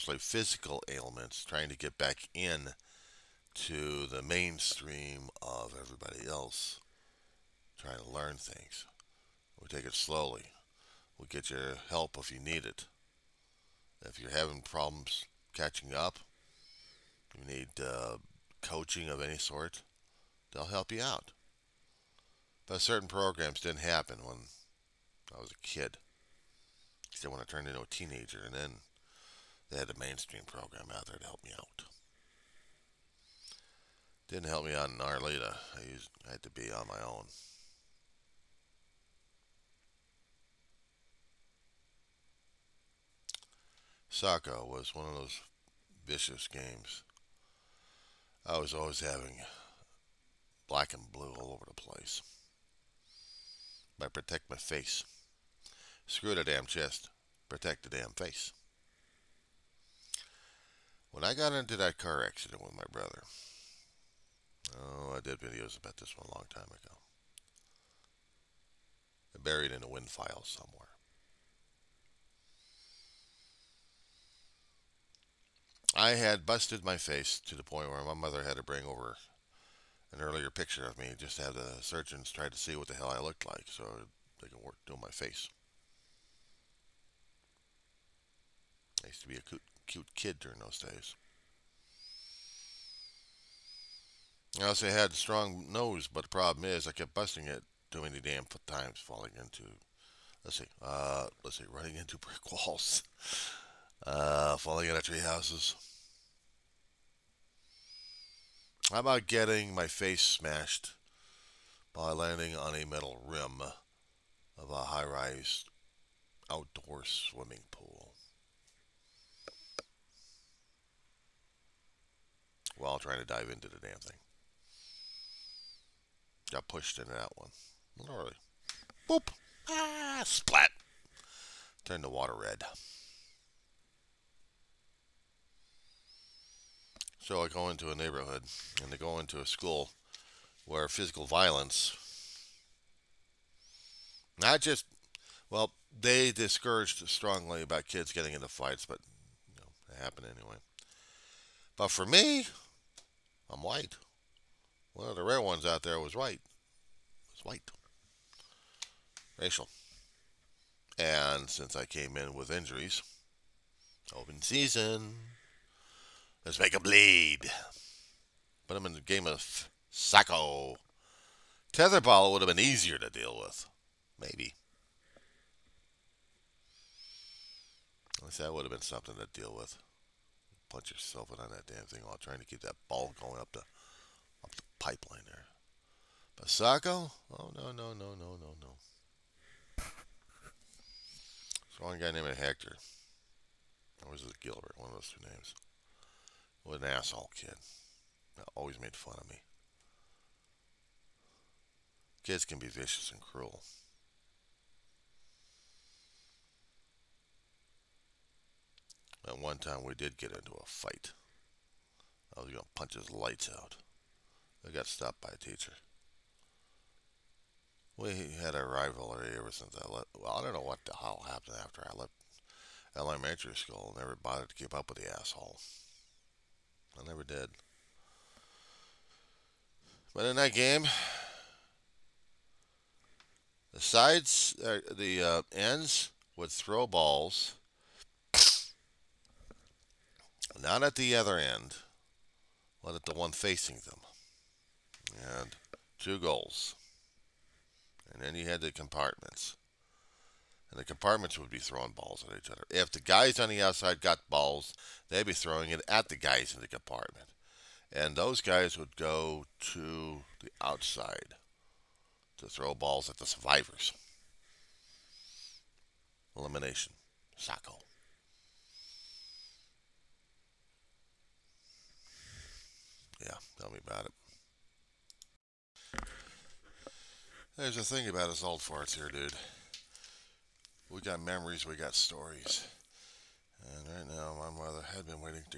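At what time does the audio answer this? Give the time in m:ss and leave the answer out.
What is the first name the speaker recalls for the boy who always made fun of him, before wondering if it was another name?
3:12.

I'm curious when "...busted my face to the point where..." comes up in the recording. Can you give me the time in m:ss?
1:16.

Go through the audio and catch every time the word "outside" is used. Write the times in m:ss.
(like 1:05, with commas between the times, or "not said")
4:13, 4:20.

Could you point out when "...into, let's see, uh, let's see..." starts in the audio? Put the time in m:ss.
1:39.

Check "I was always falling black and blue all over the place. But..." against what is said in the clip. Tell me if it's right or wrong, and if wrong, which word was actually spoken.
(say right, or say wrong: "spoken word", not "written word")
wrong: "having", not "falling".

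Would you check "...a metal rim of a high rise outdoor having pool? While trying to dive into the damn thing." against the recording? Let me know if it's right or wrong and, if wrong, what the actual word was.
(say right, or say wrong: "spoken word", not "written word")
wrong: "swimming", not "having".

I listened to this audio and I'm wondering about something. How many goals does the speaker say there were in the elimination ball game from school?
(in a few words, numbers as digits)
2.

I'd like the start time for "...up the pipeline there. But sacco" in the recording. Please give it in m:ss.
3:04.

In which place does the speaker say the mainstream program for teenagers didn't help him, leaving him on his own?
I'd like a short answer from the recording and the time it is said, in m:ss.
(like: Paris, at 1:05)
Arleta, at 0:34.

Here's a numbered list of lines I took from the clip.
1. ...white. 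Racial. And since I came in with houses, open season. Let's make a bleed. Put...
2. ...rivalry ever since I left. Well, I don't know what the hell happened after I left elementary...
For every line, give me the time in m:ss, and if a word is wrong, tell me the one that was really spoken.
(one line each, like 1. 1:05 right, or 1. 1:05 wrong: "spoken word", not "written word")
1. 2:37 wrong: "injuries", not "houses"
2. 3:38 right.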